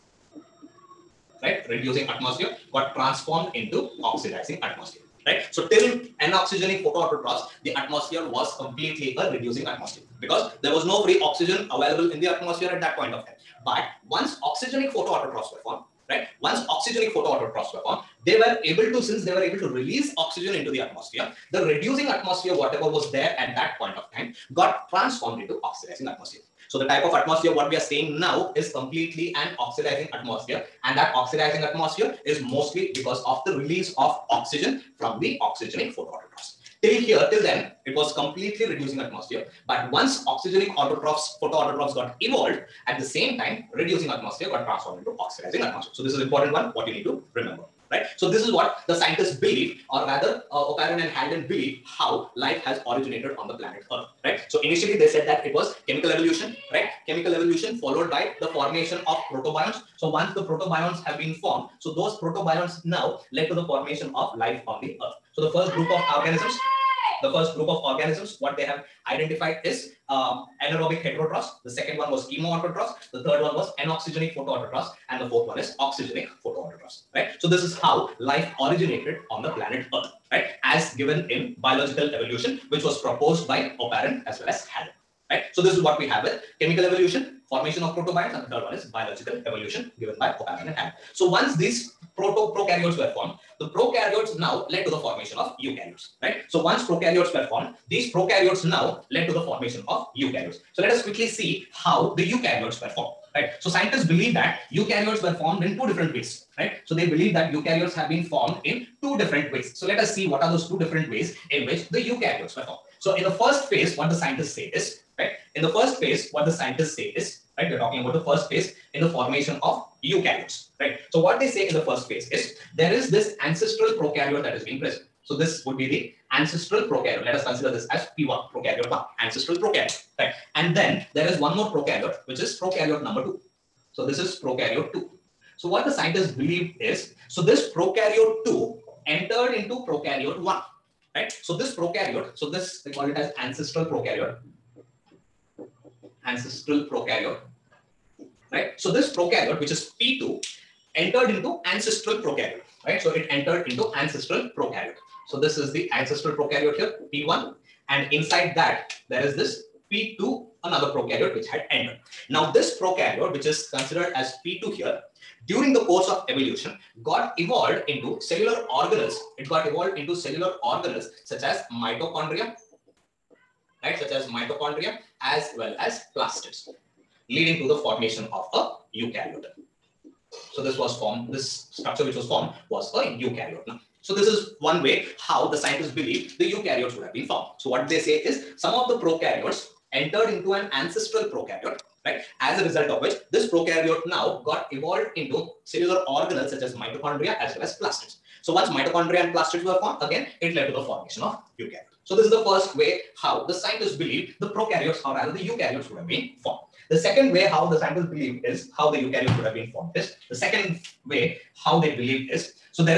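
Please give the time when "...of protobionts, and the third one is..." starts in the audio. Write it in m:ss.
1:27.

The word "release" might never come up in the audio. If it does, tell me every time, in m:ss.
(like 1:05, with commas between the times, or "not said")
0:19, 0:33.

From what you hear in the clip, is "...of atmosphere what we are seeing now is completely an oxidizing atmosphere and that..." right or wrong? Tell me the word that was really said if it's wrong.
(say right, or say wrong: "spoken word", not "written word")
right.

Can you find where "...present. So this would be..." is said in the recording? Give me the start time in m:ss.
2:04.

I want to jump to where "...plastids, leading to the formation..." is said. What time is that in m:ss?
2:56.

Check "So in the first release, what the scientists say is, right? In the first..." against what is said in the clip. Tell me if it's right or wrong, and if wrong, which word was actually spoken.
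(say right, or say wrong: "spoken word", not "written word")
wrong: "phase", not "release".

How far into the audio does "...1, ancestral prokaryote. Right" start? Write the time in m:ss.
2:08.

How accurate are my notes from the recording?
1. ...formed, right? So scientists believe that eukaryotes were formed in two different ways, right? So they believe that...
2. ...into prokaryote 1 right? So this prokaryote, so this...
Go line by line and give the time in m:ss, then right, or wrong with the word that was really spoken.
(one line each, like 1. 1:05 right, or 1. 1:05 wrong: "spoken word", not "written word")
1. 1:42 right
2. 2:19 right.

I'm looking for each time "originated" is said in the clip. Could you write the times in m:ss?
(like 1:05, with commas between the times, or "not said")
0:52, 1:18.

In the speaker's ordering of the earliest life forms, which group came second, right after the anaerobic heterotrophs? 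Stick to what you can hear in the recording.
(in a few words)
Chemoautotrophs.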